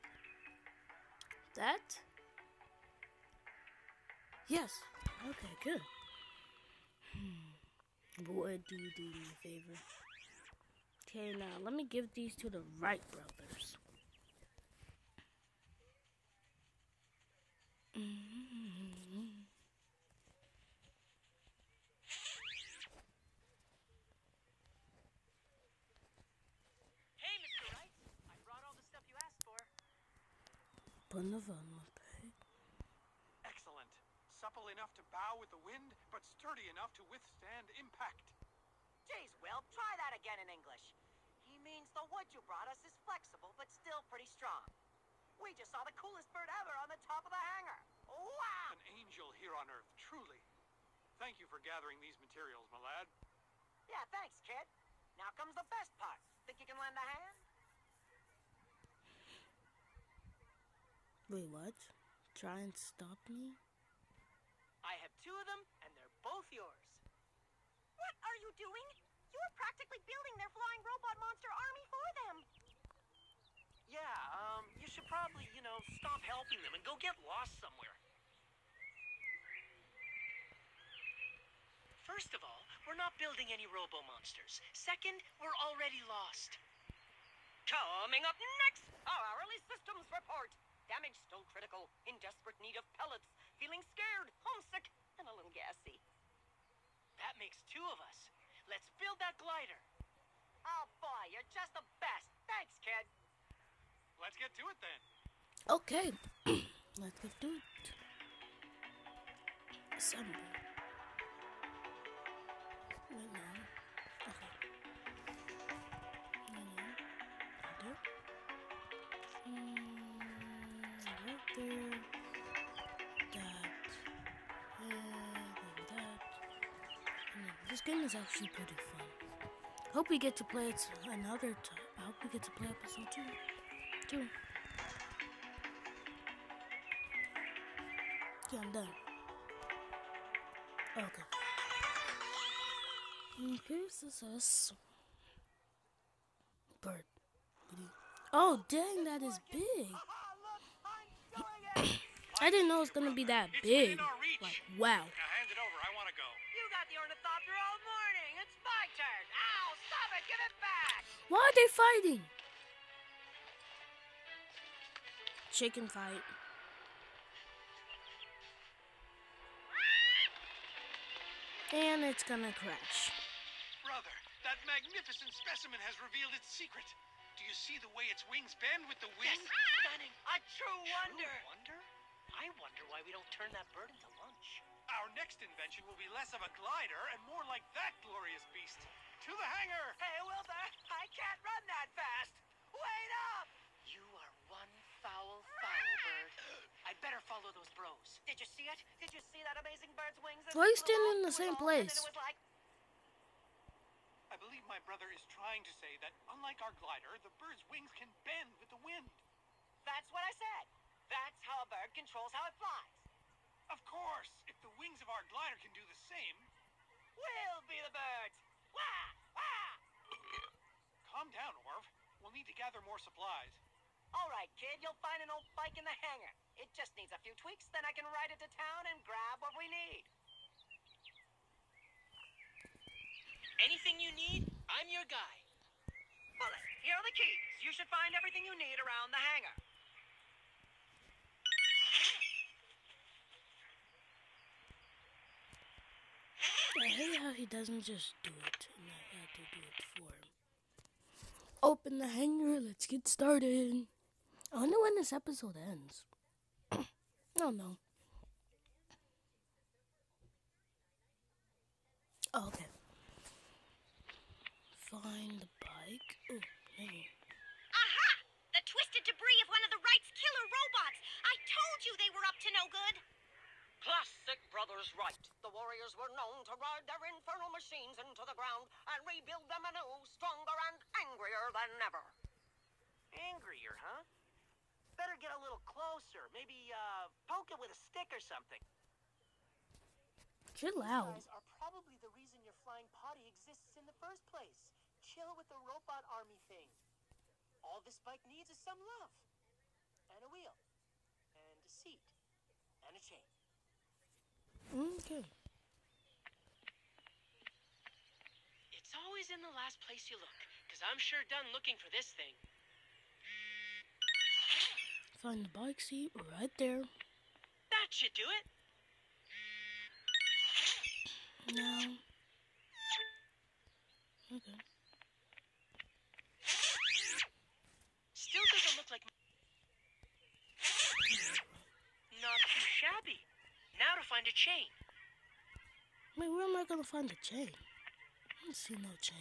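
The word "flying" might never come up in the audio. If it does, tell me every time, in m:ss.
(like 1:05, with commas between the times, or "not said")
1:10, 4:52.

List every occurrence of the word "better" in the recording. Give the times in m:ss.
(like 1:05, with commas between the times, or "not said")
3:17, 4:44.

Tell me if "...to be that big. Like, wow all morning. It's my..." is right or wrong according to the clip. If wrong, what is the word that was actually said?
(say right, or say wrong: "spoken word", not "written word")
right.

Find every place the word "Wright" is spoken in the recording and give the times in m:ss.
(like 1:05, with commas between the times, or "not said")
0:12, 4:29, 4:34.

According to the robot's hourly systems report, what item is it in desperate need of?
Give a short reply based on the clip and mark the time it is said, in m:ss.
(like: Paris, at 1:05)
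Pellets, at 1:33.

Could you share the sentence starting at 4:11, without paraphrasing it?
Open the hangar, let's get started.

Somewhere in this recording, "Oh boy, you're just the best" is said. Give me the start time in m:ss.
1:40.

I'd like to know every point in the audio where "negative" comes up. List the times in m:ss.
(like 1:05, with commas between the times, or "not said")
not said.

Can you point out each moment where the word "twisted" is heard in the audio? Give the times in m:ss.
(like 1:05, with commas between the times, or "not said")
4:28.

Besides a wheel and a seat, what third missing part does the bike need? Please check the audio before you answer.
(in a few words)
A chain.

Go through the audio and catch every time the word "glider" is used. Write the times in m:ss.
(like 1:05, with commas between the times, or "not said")
1:39, 3:06, 3:26, 3:35.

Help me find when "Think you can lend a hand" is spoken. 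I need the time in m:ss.
0:56.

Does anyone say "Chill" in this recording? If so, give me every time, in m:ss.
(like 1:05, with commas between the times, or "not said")
4:50, 4:55.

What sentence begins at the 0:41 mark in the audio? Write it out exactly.
He means the wood you brought us is flexible, but still pretty strong.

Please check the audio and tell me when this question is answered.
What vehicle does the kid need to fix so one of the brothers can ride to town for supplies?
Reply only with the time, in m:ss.
3:45.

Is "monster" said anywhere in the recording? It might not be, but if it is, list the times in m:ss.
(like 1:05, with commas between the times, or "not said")
1:11, 1:23.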